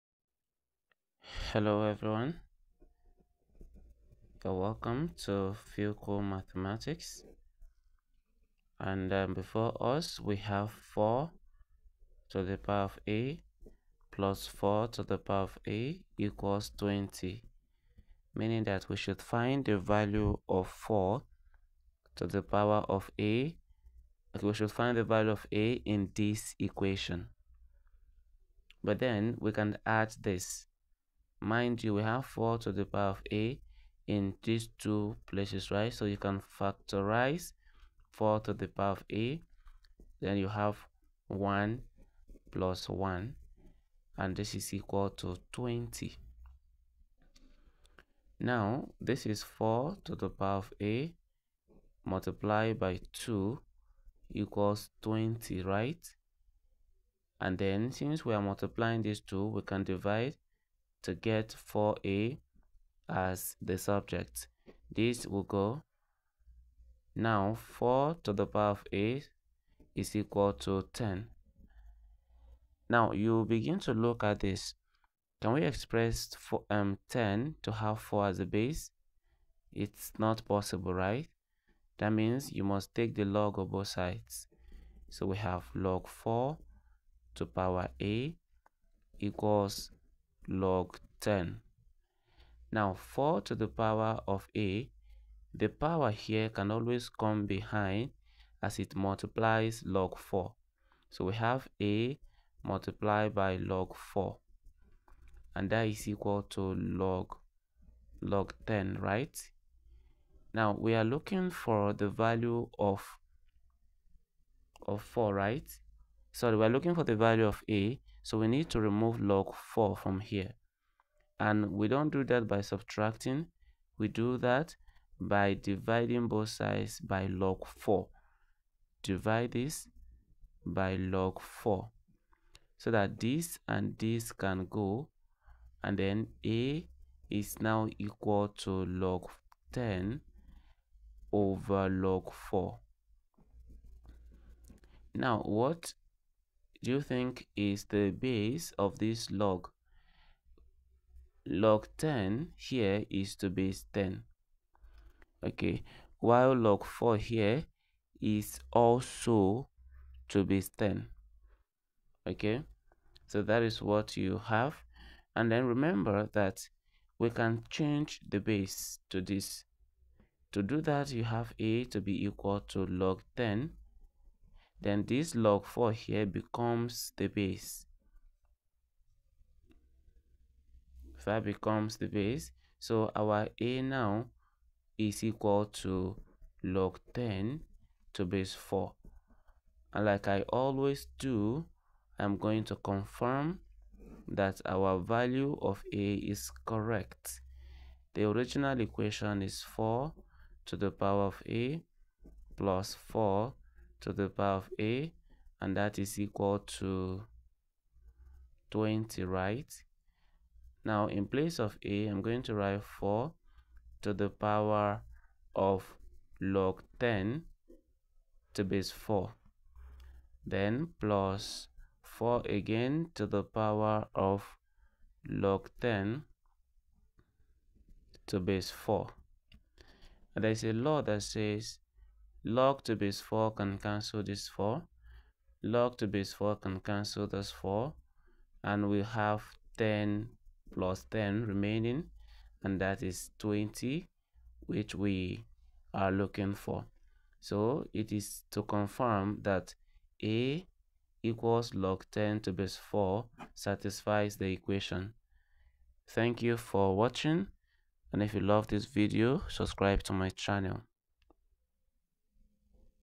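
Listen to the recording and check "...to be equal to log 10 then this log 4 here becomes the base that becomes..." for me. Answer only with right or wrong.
right.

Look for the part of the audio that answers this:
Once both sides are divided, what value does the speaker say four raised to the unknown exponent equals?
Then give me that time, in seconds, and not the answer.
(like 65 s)
67 s.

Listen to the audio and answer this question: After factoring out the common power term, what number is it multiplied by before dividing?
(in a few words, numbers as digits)
2.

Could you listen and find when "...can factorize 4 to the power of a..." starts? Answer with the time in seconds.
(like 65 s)
36 s.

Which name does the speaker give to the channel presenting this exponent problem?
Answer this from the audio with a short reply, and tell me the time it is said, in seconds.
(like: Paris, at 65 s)
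Phil Cool mathematics, at 5 s.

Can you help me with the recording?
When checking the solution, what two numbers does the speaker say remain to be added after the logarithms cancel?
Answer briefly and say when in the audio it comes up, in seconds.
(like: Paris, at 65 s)
10 plus 10, at 239 s.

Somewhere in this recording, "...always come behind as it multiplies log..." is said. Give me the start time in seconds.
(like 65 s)
96 s.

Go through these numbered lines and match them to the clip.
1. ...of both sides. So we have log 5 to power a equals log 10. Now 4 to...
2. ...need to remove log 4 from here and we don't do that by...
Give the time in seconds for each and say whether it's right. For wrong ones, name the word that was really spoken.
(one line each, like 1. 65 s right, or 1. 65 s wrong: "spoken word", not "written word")
1. 83 s wrong: "4", not "5"
2. 118 s right.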